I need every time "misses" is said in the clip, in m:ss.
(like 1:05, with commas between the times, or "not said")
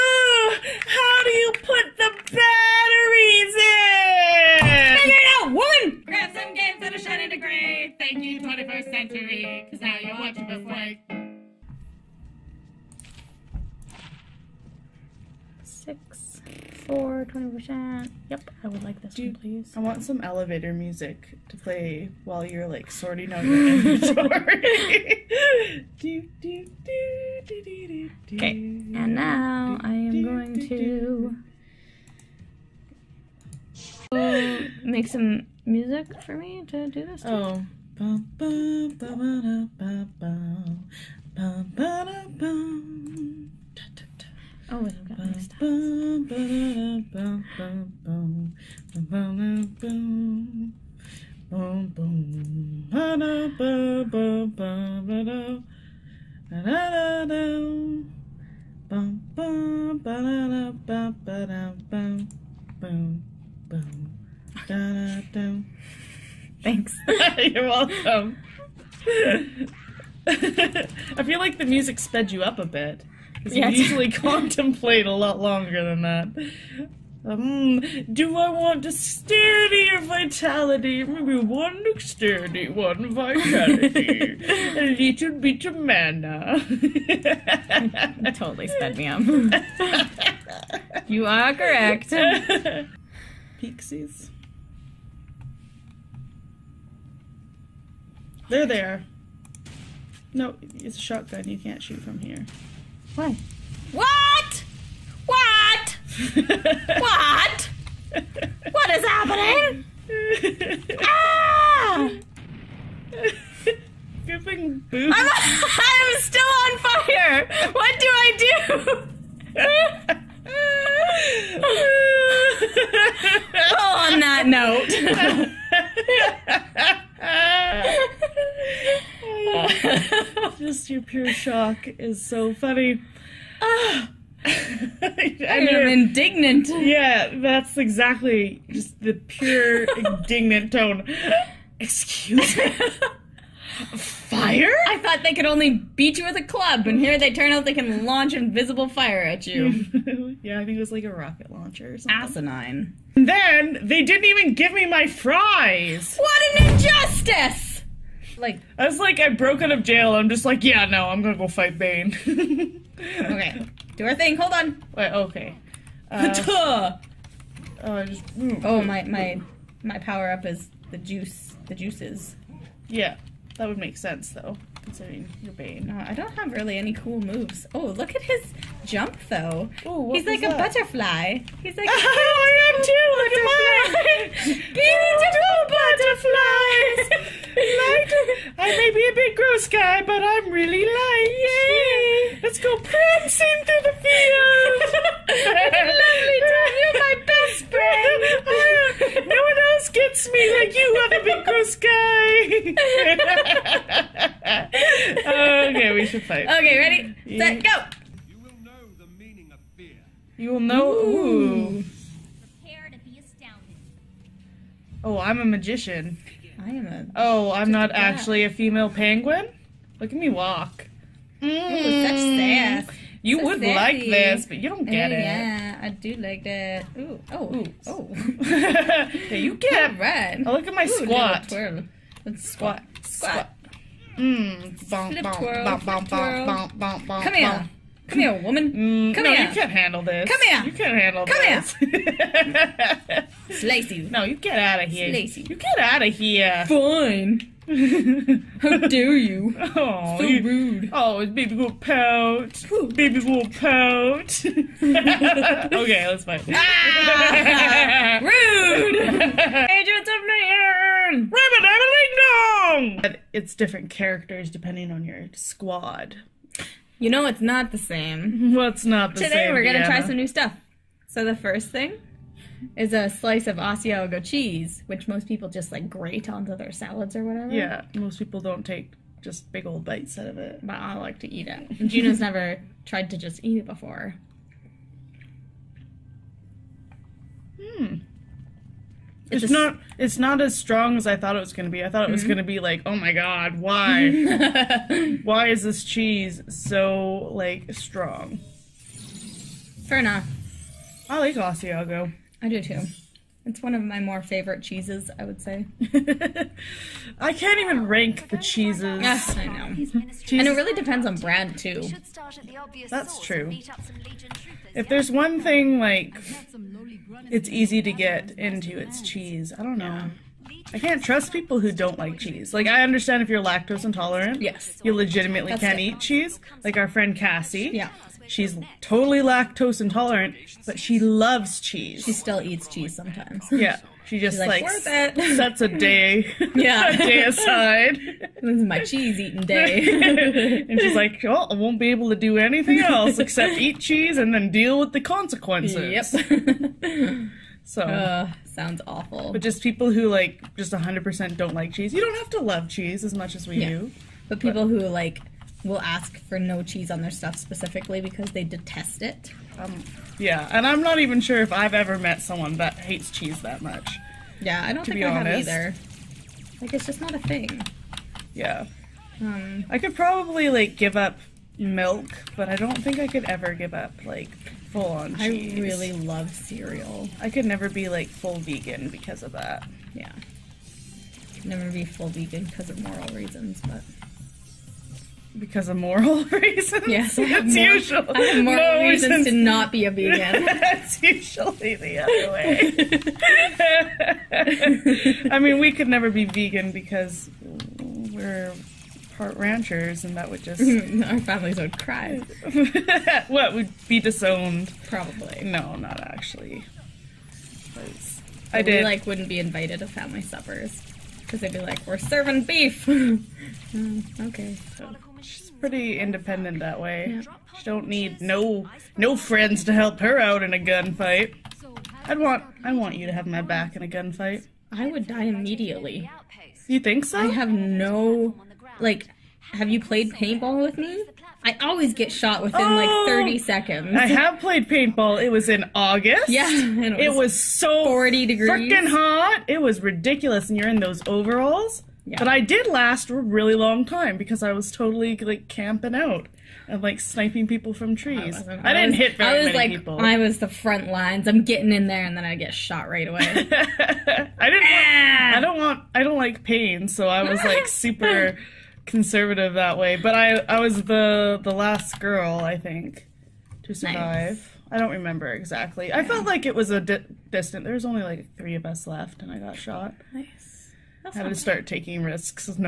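not said.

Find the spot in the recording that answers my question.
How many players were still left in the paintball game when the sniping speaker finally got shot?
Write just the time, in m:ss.
7:48.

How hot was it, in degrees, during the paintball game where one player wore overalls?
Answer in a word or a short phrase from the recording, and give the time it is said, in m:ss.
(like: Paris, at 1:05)
40 degrees, at 7:17.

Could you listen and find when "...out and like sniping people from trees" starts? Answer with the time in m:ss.
7:25.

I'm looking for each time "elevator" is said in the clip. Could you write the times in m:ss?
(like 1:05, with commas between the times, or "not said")
0:20.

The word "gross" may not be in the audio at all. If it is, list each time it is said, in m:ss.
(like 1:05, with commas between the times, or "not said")
3:09, 3:21.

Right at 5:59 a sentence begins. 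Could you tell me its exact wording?
Um, yeah, and I'm not even sure if I've ever met someone that hates cheese that much.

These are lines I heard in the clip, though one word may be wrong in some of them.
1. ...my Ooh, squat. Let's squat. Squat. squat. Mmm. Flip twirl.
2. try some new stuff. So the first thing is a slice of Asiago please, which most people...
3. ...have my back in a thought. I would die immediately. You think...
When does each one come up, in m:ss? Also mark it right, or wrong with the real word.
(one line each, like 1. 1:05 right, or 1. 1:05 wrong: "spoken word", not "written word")
1. 3:50 right
2. 4:29 wrong: "cheese", not "please"
3. 7:03 wrong: "gunfight", not "thought".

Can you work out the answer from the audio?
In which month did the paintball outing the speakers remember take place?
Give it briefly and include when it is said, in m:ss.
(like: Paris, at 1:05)
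August, at 7:15.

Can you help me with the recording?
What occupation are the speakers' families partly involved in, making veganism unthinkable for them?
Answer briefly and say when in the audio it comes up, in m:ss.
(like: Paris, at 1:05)
ranchers, at 6:39.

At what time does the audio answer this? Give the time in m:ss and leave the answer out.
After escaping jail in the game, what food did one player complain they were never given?
2:35.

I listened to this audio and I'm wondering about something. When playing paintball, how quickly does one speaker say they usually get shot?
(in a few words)
30 seconds.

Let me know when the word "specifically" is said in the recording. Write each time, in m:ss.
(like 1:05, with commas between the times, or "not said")
5:57.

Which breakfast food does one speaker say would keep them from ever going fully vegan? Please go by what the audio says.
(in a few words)
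cereal.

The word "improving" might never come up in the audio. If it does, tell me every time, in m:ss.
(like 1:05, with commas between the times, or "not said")
not said.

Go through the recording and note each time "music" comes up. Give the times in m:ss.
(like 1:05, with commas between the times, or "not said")
0:20, 0:35, 1:11.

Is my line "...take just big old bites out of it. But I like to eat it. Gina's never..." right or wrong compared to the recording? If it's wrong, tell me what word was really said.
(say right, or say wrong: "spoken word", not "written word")
right.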